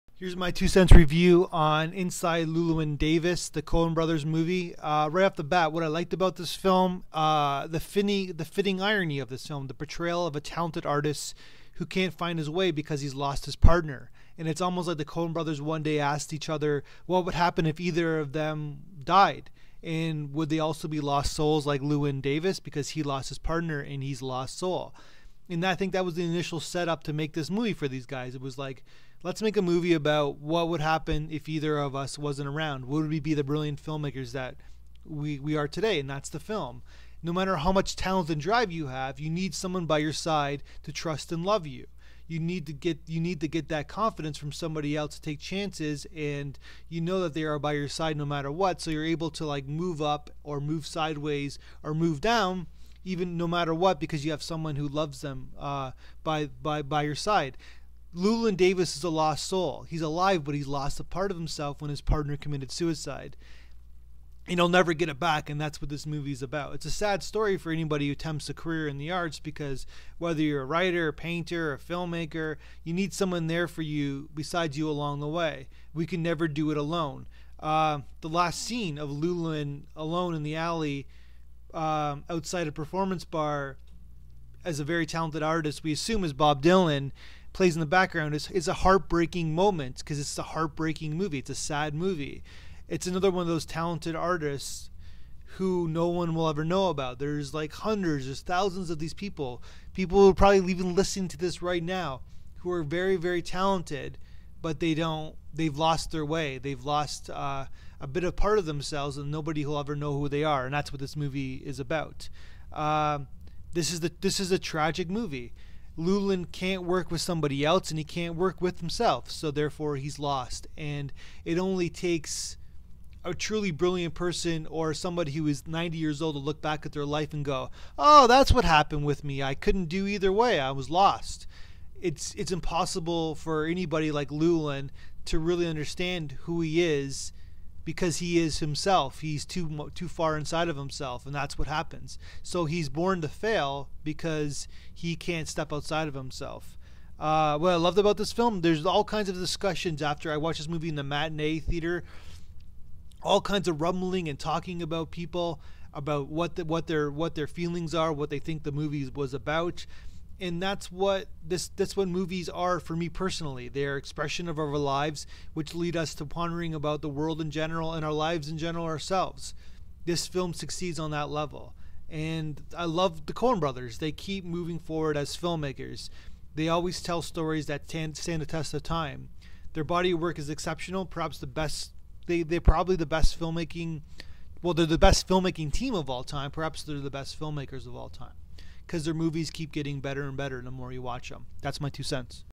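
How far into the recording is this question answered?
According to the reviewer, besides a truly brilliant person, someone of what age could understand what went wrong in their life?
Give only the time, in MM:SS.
02:05.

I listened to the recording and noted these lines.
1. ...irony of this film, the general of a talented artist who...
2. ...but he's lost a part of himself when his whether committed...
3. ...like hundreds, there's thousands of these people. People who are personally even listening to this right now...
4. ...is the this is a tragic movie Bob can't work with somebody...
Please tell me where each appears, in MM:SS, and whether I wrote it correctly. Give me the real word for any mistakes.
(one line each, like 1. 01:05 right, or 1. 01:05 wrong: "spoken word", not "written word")
1. 00:08 wrong: "portrayal", not "general"
2. 01:00 wrong: "partner", not "whether"
3. 01:37 wrong: "probably", not "personally"
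4. 01:53 wrong: "Llewyn", not "Bob".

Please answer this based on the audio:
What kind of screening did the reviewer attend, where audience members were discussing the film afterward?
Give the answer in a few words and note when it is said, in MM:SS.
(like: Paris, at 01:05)
Matinee, at 02:31.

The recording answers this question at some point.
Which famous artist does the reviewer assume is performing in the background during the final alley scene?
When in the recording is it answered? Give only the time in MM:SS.
01:26.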